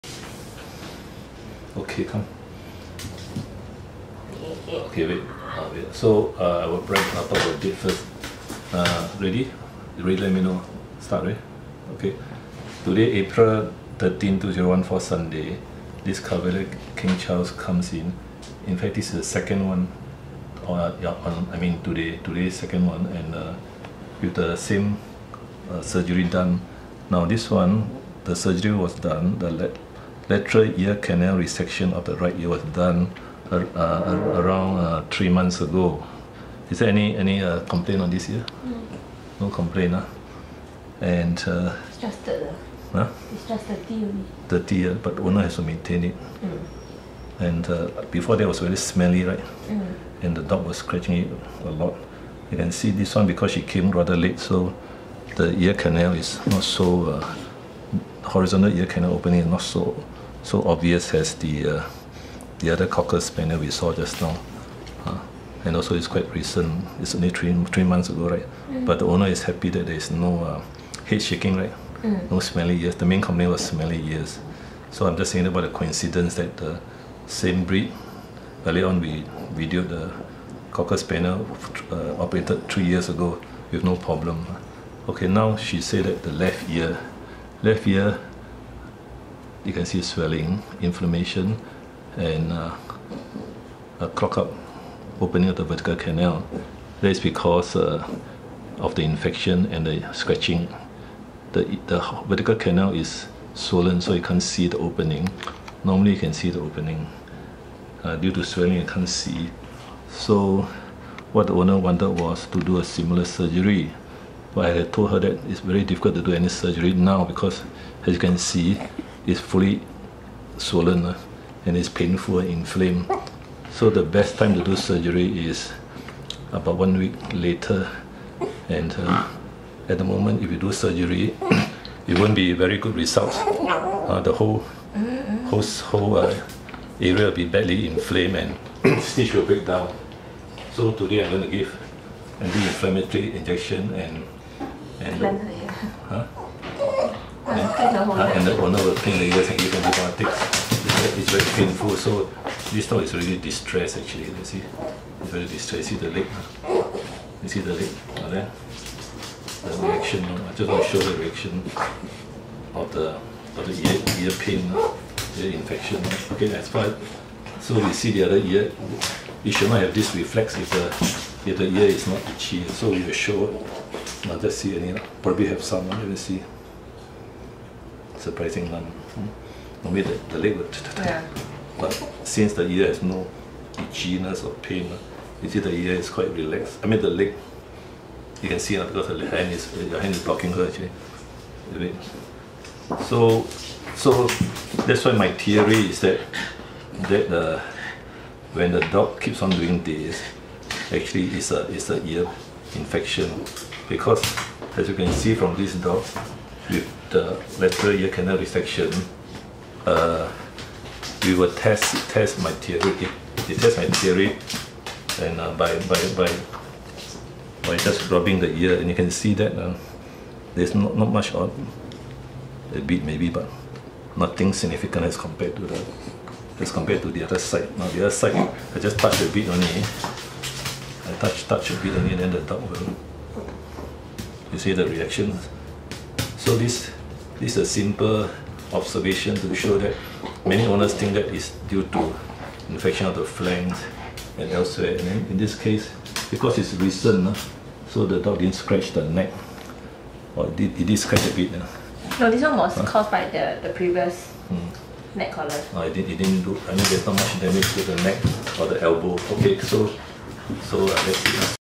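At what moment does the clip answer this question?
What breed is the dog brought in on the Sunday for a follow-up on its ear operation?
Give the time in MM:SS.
00:16.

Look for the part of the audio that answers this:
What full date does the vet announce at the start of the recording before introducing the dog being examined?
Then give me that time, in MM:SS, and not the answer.
00:13.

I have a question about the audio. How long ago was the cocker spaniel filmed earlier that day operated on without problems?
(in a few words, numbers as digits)
three years ago.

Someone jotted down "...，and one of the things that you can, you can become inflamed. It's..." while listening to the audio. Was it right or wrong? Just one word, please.
wrong.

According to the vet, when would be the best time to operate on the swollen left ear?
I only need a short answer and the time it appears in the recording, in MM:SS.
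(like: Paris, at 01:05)
about one week later, at 02:06.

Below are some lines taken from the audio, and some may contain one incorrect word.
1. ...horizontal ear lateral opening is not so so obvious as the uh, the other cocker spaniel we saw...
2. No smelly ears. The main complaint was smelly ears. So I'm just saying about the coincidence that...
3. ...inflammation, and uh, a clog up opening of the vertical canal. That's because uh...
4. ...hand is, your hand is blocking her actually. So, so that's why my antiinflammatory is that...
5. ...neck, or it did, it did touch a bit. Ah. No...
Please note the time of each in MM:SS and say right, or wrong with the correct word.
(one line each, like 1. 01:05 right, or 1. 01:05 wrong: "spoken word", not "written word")
1. 00:58 wrong: "canal", not "lateral"
2. 01:12 right
3. 01:30 right
4. 03:09 wrong: "theory", not "antiinflammatory"
5. 04:09 wrong: "scratch", not "touch".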